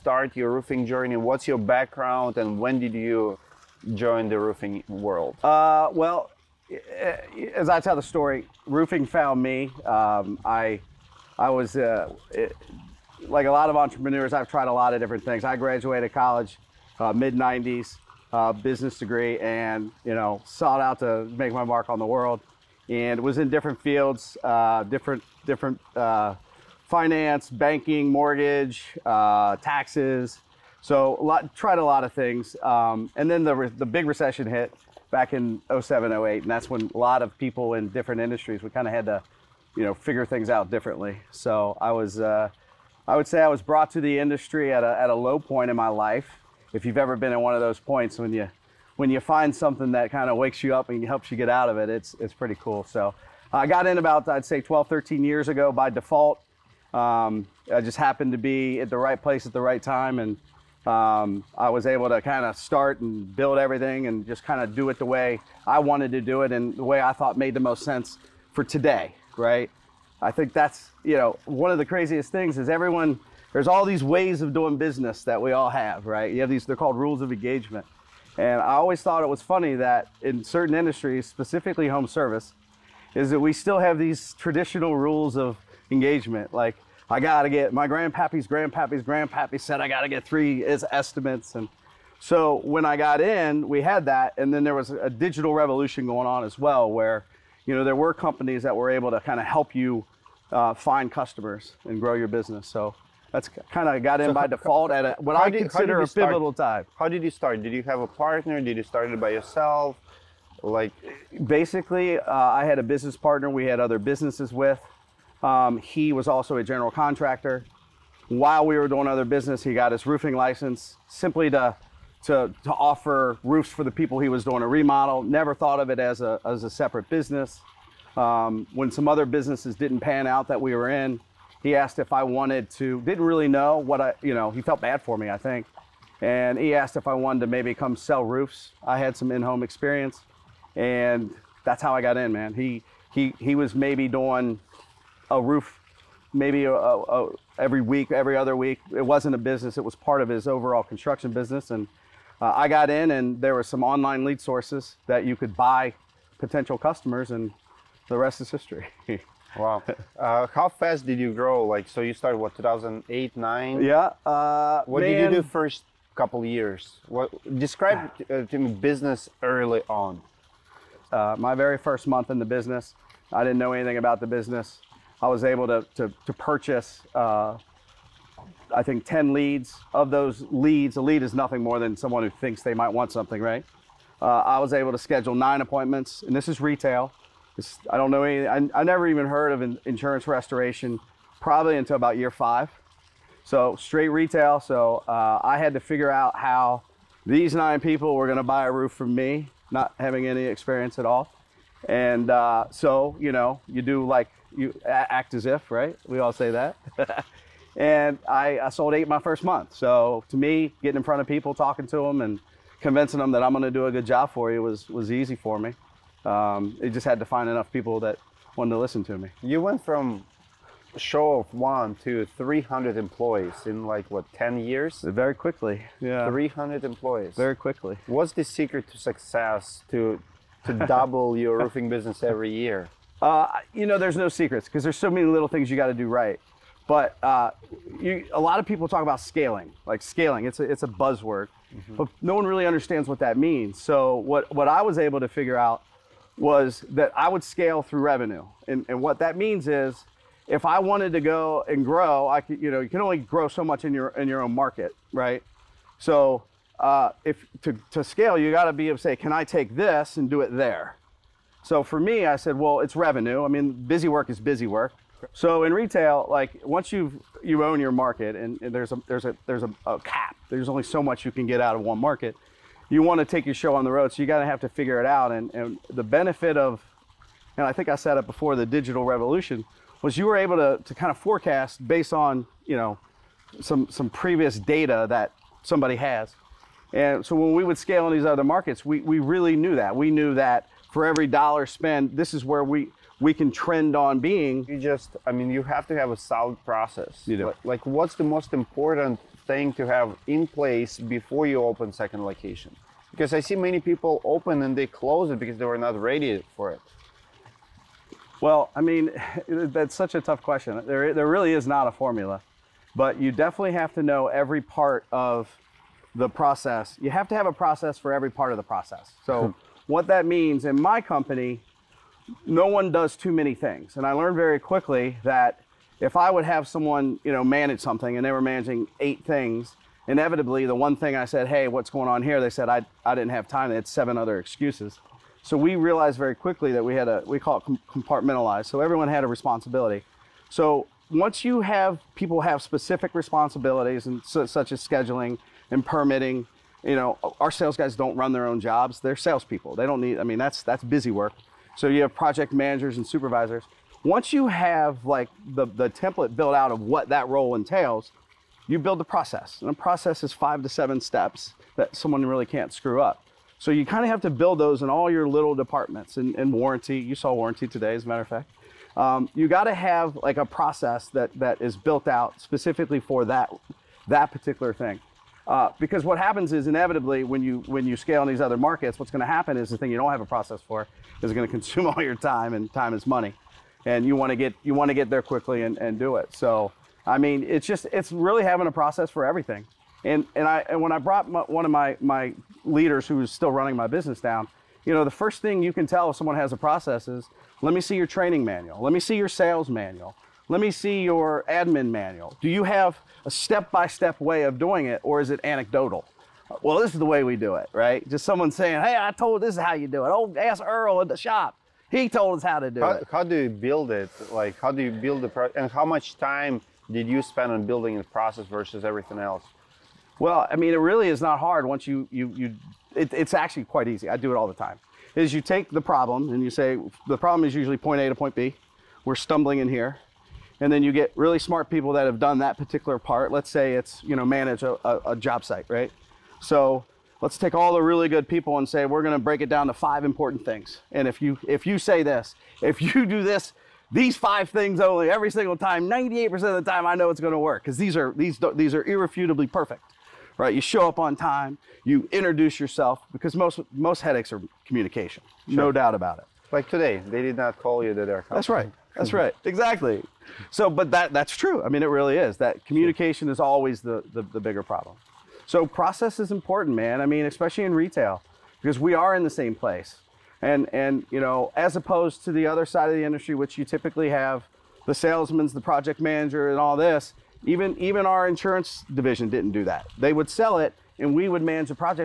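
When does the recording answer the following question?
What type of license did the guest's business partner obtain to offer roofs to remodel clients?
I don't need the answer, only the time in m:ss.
2:00.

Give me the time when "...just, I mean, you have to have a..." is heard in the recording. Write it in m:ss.
4:54.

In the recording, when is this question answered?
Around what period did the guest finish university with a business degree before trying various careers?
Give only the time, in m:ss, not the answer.
0:17.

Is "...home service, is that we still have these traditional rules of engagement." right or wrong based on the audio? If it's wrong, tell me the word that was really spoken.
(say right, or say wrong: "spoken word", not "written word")
right.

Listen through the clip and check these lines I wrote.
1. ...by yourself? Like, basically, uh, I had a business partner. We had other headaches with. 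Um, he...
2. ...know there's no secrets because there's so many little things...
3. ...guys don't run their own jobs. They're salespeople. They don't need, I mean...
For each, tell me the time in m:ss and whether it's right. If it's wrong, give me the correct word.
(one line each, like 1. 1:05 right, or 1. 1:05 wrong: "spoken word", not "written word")
1. 1:49 wrong: "businesses", not "headaches"
2. 3:53 right
3. 5:47 right.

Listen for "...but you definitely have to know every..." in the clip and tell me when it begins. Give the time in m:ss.
5:12.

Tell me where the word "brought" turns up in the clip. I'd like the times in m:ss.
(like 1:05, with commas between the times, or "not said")
0:43, 6:30.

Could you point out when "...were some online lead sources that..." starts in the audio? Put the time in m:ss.
2:33.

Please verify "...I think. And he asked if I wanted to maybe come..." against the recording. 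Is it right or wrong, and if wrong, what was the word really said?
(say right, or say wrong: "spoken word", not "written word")
right.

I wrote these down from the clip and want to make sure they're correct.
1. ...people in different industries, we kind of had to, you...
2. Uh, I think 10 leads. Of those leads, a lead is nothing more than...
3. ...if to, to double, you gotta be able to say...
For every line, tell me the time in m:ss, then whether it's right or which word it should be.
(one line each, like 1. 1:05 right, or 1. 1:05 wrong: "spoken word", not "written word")
1. 0:37 right
2. 2:57 right
3. 4:17 wrong: "scale", not "double".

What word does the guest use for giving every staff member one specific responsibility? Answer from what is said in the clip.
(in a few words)
compartmentalized.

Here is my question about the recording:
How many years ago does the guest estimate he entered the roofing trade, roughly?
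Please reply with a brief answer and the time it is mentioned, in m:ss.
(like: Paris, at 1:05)
12, 13 years, at 0:54.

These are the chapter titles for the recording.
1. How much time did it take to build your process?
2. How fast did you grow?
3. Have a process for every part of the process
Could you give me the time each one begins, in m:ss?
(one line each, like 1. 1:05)
1. 6:54
2. 2:41
3. 5:17.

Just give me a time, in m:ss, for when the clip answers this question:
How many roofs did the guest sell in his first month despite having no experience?
3:28.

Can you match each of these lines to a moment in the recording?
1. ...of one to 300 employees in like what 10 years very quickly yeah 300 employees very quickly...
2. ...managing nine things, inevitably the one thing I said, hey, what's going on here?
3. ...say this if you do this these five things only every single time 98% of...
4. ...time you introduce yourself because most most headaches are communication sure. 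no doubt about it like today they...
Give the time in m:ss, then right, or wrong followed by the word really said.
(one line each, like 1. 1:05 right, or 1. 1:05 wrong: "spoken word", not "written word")
1. 3:41 right
2. 5:28 wrong: "eight", not "nine"
3. 7:21 right
4. 7:31 right.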